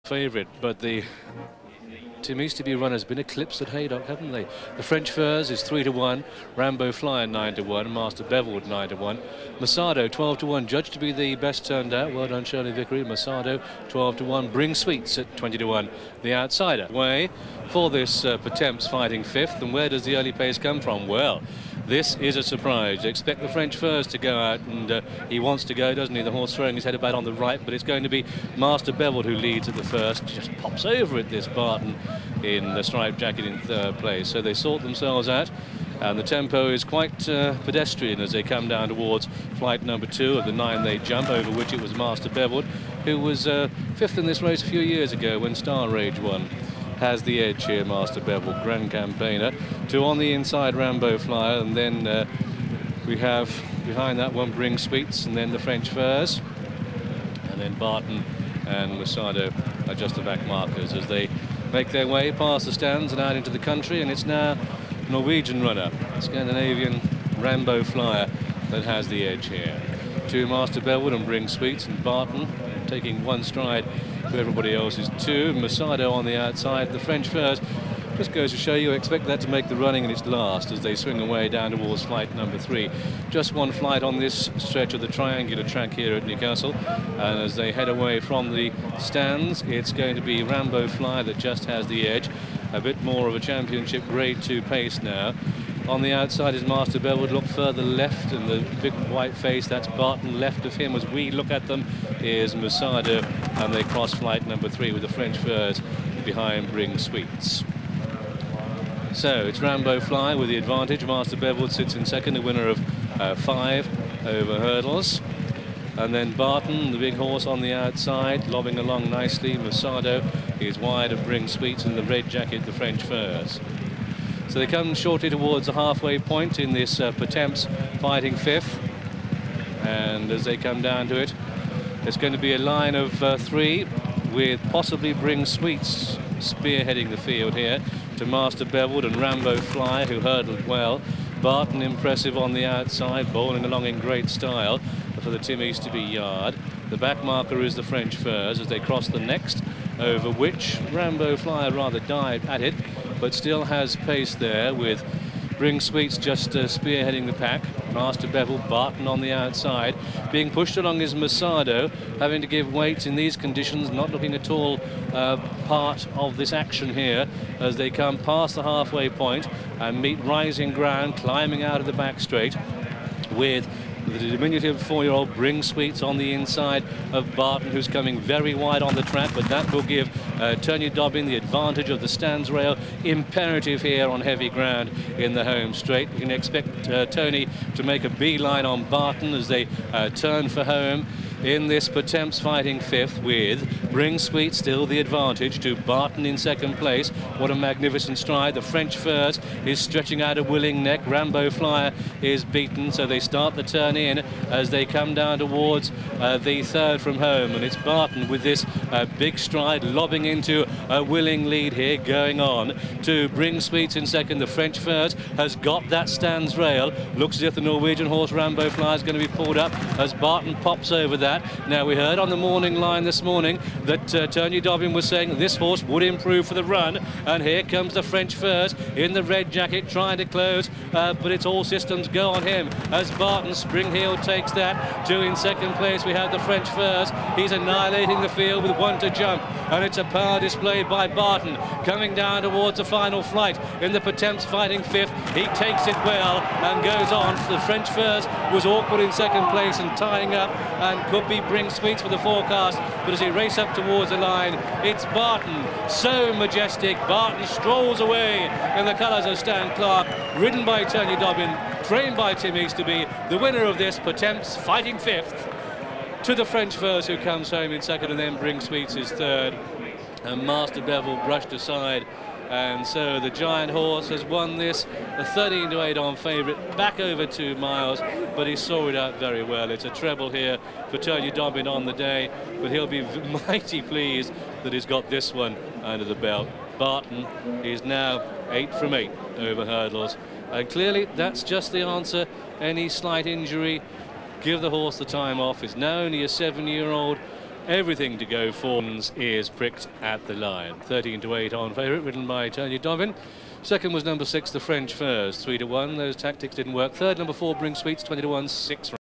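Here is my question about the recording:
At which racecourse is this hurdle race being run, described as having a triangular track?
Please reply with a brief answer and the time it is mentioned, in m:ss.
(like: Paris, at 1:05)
Newcastle, at 1:26.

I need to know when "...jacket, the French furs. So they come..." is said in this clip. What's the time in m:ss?
2:02.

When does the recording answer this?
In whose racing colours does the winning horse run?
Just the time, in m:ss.
4:19.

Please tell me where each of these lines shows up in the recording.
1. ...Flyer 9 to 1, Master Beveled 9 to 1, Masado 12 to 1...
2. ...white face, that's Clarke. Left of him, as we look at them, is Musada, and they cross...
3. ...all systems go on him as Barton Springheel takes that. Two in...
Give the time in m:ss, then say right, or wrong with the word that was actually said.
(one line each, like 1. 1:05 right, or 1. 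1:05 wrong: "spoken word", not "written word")
1. 0:06 right
2. 1:39 wrong: "Barton", not "Clarke"
3. 3:51 right.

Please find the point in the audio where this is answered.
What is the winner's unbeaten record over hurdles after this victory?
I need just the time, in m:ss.
4:48.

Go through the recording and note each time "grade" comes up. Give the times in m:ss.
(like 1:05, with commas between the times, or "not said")
1:34.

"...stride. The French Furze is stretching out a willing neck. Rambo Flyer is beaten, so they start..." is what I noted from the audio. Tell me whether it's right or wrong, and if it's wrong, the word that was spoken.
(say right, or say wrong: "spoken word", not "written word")
right.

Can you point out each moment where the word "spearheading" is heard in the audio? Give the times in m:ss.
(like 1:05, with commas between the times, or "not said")
2:16, 2:36.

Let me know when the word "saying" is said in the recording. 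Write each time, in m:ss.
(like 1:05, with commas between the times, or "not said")
3:45.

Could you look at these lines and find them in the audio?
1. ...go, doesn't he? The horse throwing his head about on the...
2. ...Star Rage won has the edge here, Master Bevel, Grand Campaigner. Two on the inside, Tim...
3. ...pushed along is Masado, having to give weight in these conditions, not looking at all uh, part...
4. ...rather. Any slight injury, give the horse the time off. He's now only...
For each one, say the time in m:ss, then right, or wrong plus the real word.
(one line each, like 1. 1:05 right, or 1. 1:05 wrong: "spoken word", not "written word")
1. 0:25 right
2. 0:45 wrong: "Rambo", not "Tim"
3. 2:40 right
4. 4:51 wrong: "answer", not "rather".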